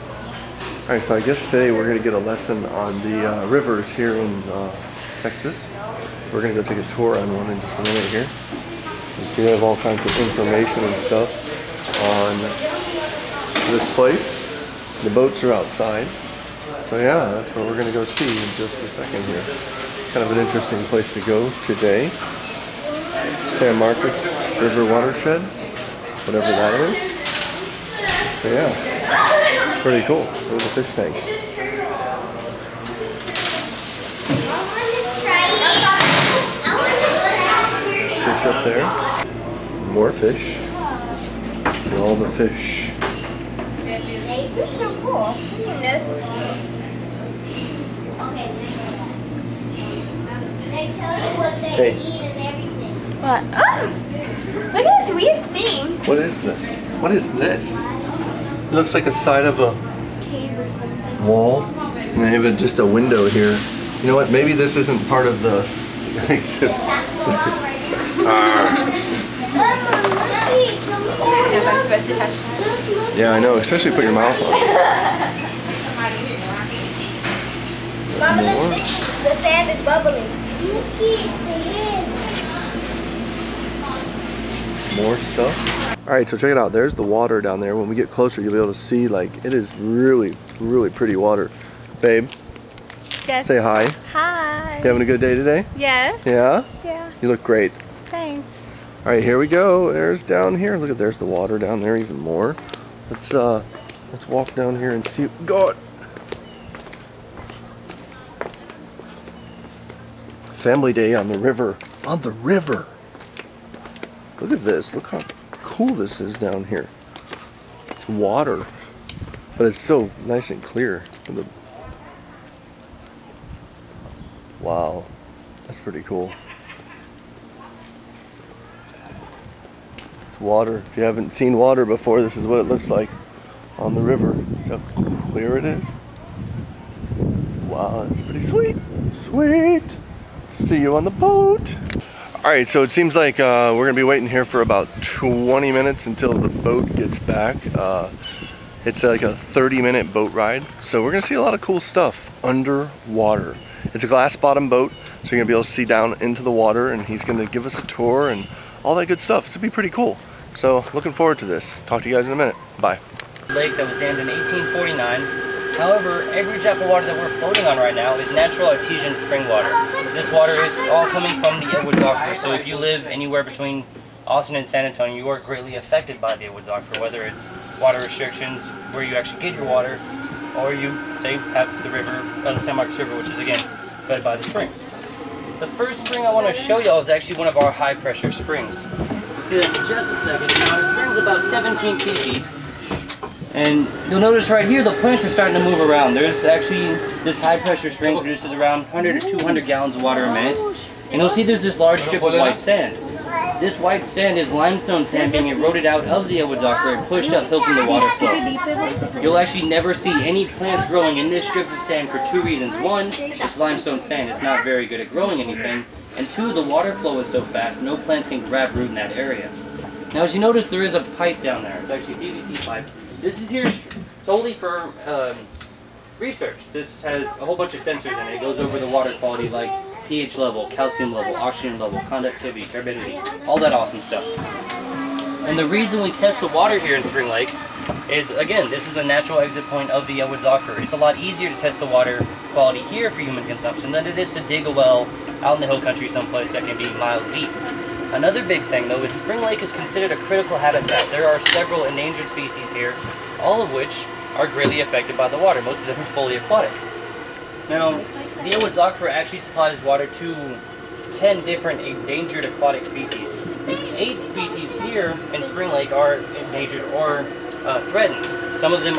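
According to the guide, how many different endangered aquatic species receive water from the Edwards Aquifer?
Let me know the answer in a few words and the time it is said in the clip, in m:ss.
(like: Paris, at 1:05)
10, at 4:21.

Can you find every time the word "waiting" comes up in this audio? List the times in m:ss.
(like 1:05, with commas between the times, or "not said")
2:24.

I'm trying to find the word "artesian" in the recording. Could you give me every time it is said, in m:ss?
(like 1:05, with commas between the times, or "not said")
2:48.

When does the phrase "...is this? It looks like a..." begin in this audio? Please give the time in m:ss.
0:57.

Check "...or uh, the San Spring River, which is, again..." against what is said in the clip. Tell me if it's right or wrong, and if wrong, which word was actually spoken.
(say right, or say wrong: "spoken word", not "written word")
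wrong: "Marcos", not "Spring".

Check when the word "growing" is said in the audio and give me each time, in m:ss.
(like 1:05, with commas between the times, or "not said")
3:30, 3:35.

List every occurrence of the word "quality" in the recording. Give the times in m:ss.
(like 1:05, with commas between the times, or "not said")
3:49, 4:02.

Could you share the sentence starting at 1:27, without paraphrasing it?
When we get closer, you'll be able to see, like, it is really, really pretty water.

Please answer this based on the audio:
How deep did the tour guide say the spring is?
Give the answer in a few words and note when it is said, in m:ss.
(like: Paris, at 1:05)
17 feet, at 3:11.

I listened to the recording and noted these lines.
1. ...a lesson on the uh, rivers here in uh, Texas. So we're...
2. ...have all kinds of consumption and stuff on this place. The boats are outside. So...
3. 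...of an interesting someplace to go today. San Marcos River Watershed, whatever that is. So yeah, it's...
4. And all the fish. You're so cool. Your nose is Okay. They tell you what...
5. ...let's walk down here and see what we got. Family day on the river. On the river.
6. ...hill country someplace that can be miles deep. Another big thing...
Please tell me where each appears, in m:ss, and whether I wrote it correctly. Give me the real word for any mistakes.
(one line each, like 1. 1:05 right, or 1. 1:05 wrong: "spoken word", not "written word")
1. 0:02 right
2. 0:09 wrong: "information", not "consumption"
3. 0:20 wrong: "place", not "someplace"
4. 0:41 right
5. 1:44 right
6. 4:05 right.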